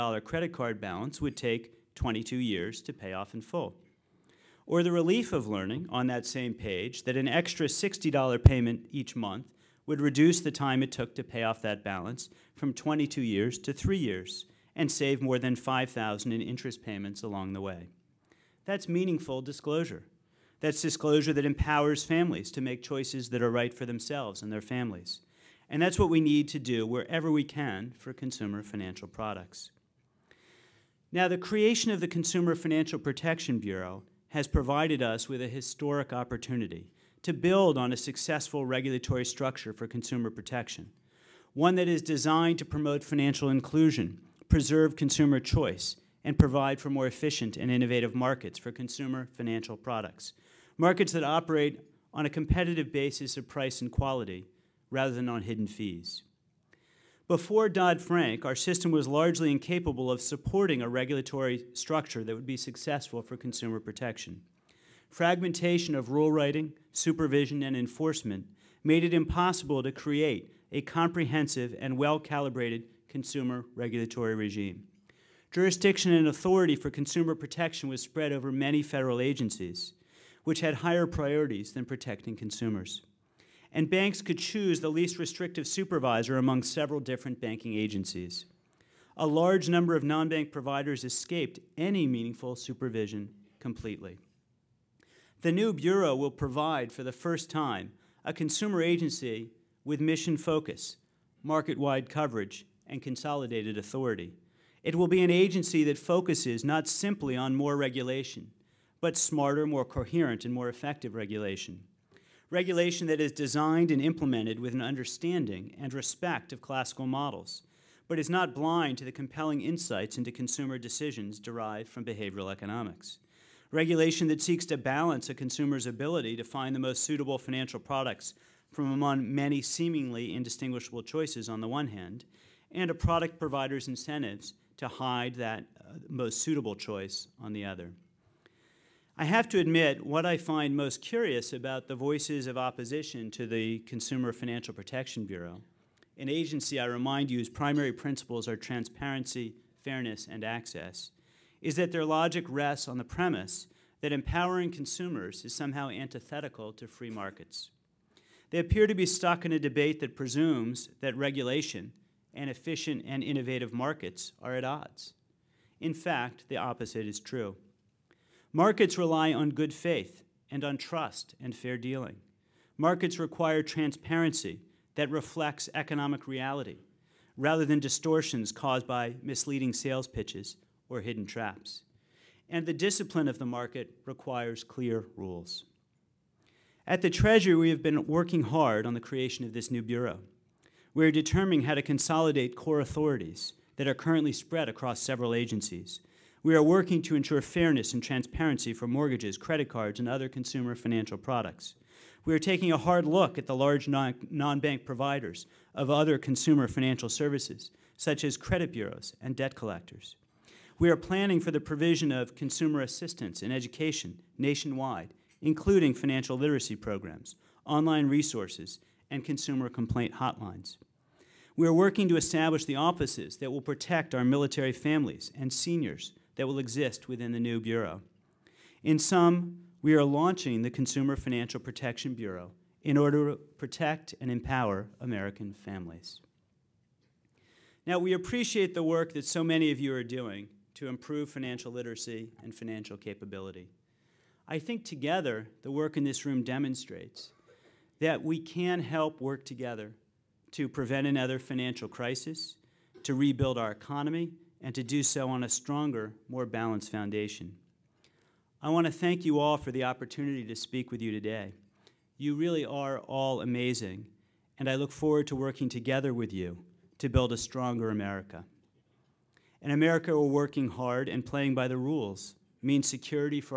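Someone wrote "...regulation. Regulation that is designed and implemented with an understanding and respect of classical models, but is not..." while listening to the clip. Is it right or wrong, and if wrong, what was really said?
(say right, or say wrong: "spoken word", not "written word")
right.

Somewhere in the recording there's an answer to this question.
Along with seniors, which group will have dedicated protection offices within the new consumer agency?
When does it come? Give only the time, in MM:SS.
03:44.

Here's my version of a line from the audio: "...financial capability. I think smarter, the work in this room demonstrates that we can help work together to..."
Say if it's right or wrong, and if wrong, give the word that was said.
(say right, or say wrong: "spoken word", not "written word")
wrong: "together", not "smarter".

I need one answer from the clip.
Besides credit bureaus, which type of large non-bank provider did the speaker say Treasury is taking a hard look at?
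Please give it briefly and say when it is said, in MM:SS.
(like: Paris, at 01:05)
debt collectors, at 03:29.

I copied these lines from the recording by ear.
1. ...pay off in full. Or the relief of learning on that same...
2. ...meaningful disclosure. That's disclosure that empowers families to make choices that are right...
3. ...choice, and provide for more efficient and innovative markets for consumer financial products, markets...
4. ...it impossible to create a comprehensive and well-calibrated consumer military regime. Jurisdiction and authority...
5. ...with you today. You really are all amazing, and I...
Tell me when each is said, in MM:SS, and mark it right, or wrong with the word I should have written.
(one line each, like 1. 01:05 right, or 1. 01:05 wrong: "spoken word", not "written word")
1. 00:02 right
2. 00:18 right
3. 00:45 right
4. 01:09 wrong: "regulatory", not "military"
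5. 04:20 right.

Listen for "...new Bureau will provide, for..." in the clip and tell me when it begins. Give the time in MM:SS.
01:35.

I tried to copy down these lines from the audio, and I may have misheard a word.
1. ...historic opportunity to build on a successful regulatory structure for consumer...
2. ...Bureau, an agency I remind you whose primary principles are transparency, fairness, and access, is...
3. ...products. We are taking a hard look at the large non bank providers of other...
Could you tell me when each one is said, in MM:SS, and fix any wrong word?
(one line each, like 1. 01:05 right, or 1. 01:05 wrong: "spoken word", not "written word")
1. 00:35 right
2. 02:25 right
3. 03:21 right.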